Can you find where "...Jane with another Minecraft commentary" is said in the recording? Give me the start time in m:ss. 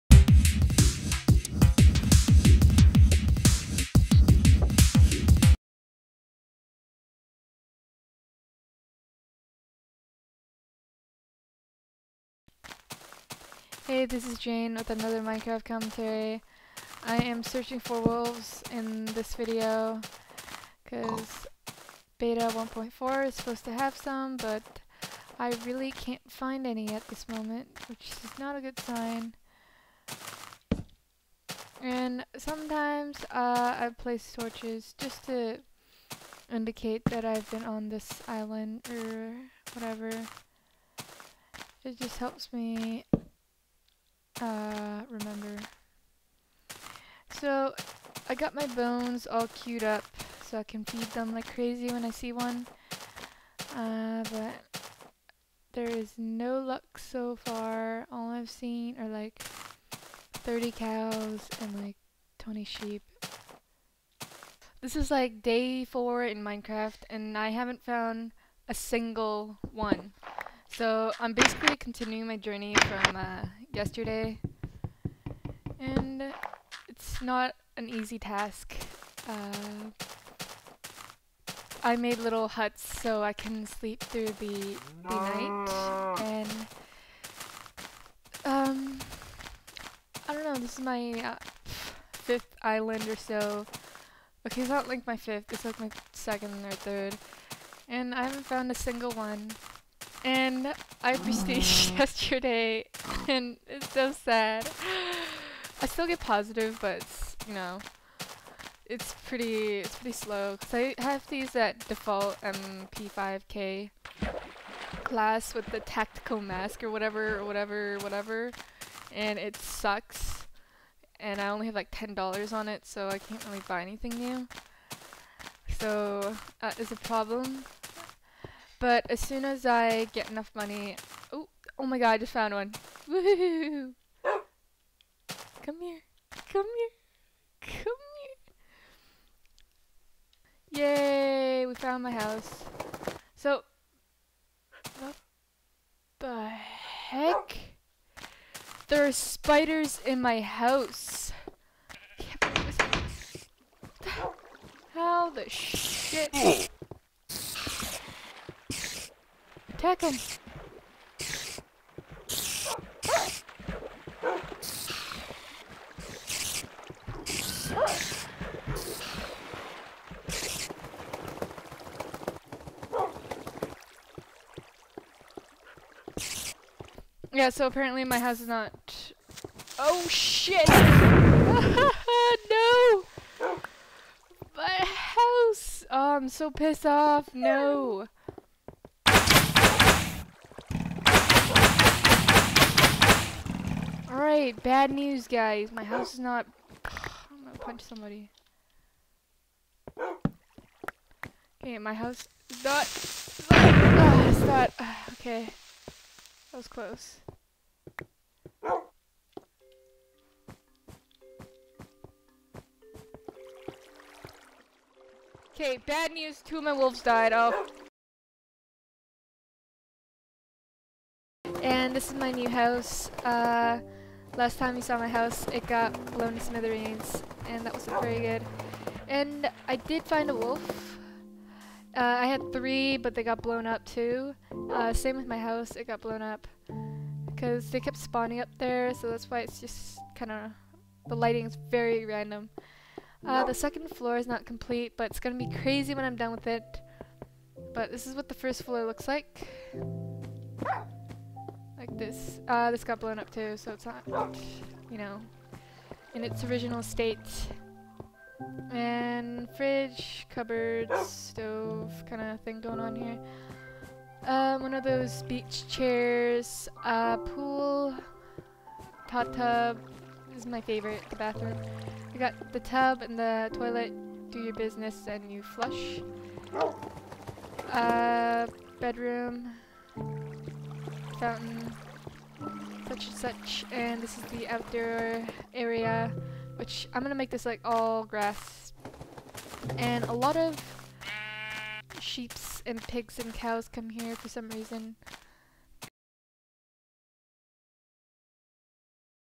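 0:14.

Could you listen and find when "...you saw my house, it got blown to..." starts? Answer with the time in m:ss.
3:44.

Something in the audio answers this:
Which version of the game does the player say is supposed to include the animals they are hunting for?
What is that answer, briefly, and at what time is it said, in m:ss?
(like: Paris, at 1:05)
beta 1.4, at 0:22.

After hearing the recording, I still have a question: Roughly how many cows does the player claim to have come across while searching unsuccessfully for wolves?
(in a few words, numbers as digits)
30.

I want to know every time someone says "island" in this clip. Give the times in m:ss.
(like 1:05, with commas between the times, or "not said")
0:38, 1:32.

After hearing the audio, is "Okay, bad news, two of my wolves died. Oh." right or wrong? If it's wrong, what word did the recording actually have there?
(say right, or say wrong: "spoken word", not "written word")
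right.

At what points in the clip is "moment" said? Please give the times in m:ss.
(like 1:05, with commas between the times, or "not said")
0:27.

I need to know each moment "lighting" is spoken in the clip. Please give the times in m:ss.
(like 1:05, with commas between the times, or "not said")
4:01.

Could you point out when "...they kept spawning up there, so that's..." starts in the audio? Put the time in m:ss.
3:57.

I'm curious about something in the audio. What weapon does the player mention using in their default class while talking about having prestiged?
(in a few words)
MP5K.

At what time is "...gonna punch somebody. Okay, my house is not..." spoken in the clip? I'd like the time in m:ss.
3:17.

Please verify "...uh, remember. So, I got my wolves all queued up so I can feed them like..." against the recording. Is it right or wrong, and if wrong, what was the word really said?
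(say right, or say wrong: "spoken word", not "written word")
wrong: "bones", not "wolves".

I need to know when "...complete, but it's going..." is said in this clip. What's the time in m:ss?
4:04.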